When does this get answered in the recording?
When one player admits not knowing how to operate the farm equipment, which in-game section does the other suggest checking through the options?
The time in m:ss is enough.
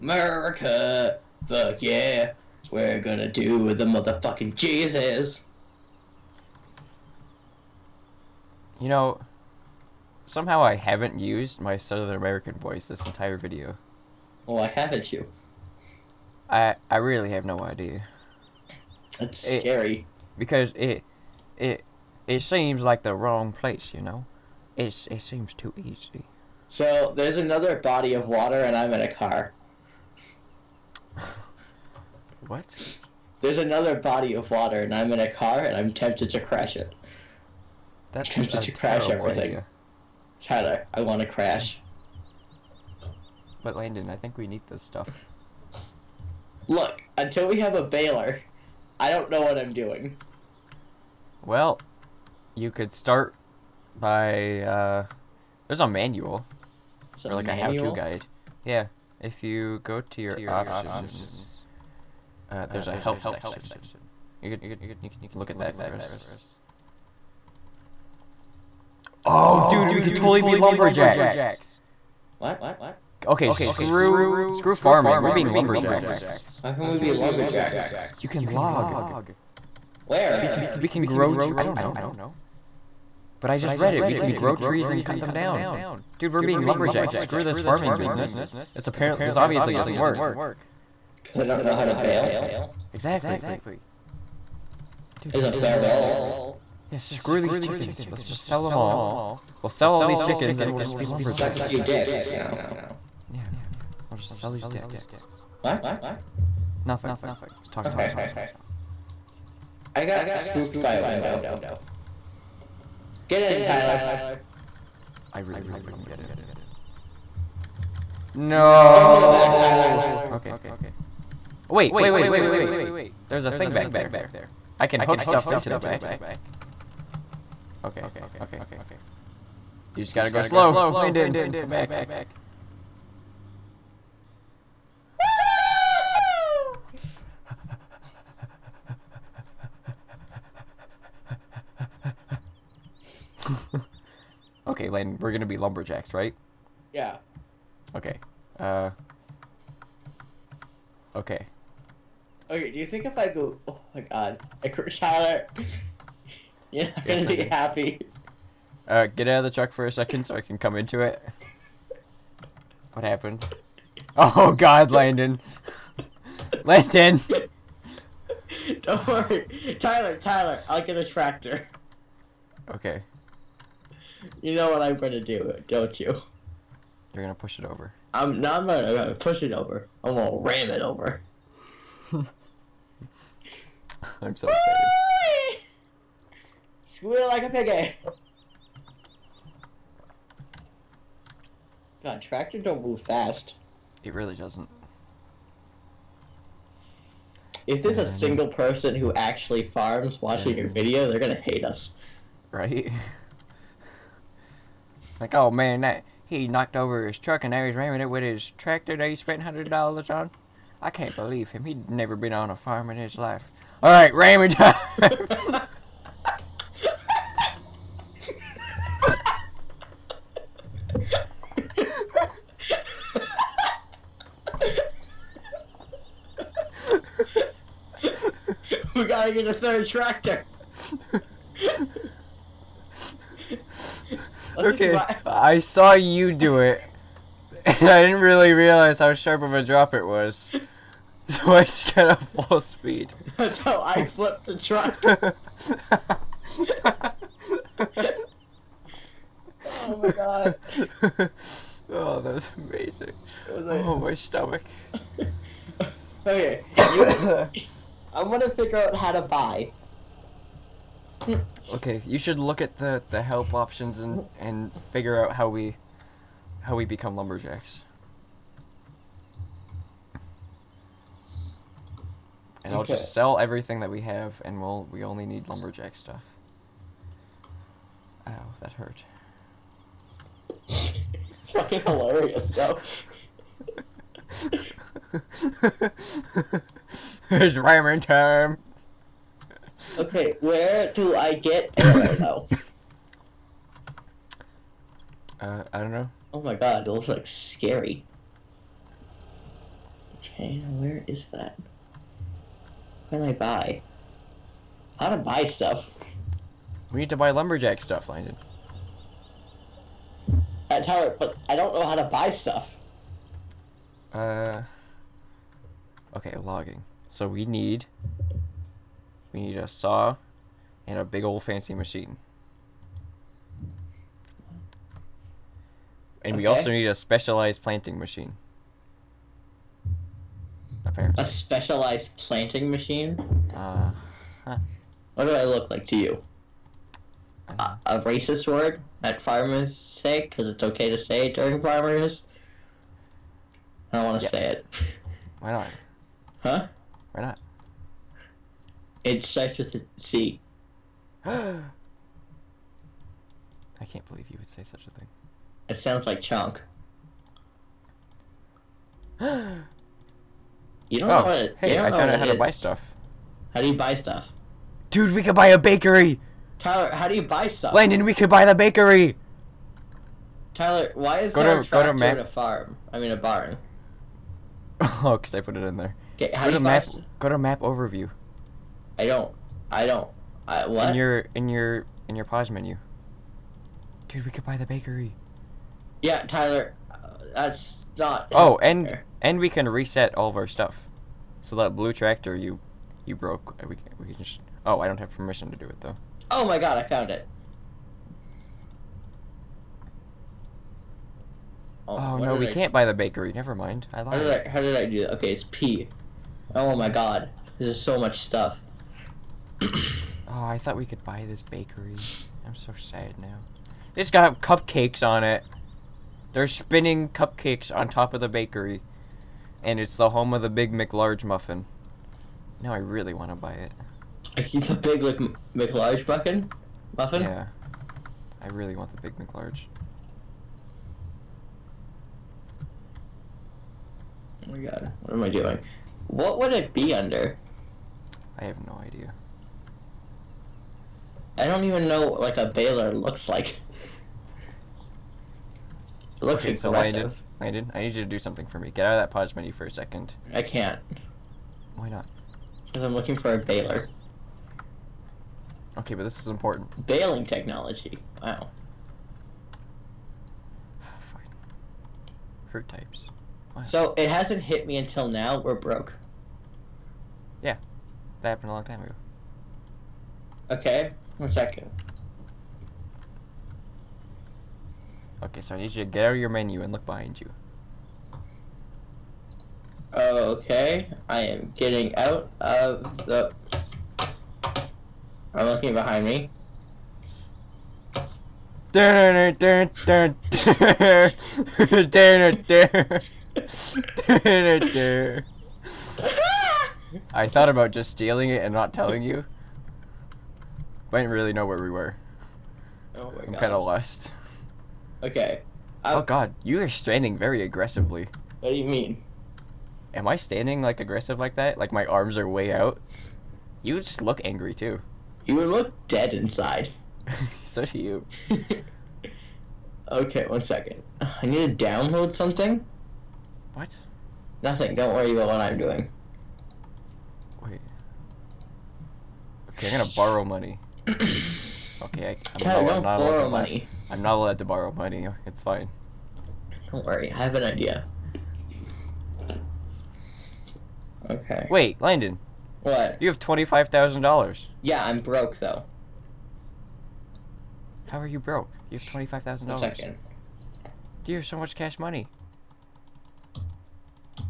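1:02.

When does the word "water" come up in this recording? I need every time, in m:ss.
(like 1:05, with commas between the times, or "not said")
0:28, 0:34.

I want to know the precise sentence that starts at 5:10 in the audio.
That's how but I don't know how to buy stuff.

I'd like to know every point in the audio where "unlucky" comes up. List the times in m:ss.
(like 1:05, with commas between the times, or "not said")
not said.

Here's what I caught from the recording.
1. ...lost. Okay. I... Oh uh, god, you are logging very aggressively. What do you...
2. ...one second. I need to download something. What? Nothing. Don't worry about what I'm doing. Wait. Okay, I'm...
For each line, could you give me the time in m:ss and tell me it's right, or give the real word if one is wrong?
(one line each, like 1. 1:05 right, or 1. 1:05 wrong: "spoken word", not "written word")
1. 8:23 wrong: "standing", not "logging"
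2. 8:40 right.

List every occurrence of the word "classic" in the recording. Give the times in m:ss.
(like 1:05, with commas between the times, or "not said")
not said.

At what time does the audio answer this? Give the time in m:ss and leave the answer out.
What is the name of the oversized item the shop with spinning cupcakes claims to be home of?
7:00.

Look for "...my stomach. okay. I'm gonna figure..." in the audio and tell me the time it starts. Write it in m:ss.
4:13.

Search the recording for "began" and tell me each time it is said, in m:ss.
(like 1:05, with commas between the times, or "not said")
not said.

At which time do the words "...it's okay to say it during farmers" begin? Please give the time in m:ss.
5:40.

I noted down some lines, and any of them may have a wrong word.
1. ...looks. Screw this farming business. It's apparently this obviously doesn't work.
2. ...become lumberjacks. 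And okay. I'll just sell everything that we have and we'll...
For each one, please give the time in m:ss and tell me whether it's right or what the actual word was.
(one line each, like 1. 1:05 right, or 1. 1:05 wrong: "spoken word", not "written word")
1. 1:26 wrong: "lumberjacks", not "looks"
2. 4:26 right.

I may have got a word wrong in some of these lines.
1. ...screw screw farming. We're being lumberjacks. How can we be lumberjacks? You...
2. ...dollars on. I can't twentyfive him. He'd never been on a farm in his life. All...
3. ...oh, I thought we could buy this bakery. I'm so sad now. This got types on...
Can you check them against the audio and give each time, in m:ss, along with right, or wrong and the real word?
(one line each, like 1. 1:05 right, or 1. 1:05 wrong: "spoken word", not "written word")
1. 1:13 right
2. 3:29 wrong: "believe", not "twentyfive"
3. 6:49 wrong: "cupcakes", not "types".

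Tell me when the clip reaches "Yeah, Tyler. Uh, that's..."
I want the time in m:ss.
6:26.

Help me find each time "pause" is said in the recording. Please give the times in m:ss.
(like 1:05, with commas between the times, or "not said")
6:22, 7:29.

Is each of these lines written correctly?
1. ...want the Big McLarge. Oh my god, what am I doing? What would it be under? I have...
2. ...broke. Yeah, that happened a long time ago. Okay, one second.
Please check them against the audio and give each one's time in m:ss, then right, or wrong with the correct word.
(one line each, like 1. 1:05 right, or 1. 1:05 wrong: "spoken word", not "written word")
1. 7:08 right
2. 7:45 right.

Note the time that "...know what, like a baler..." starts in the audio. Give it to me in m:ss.
7:21.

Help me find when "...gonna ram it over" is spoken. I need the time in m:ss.
3:00.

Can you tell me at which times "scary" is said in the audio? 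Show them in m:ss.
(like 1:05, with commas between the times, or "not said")
0:19, 4:57.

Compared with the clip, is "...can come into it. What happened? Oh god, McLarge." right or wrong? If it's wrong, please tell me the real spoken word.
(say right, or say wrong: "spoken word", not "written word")
wrong: "Landon", not "McLarge".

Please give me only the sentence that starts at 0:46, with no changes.
Look, until we have a baler, I don't know what I'm doing.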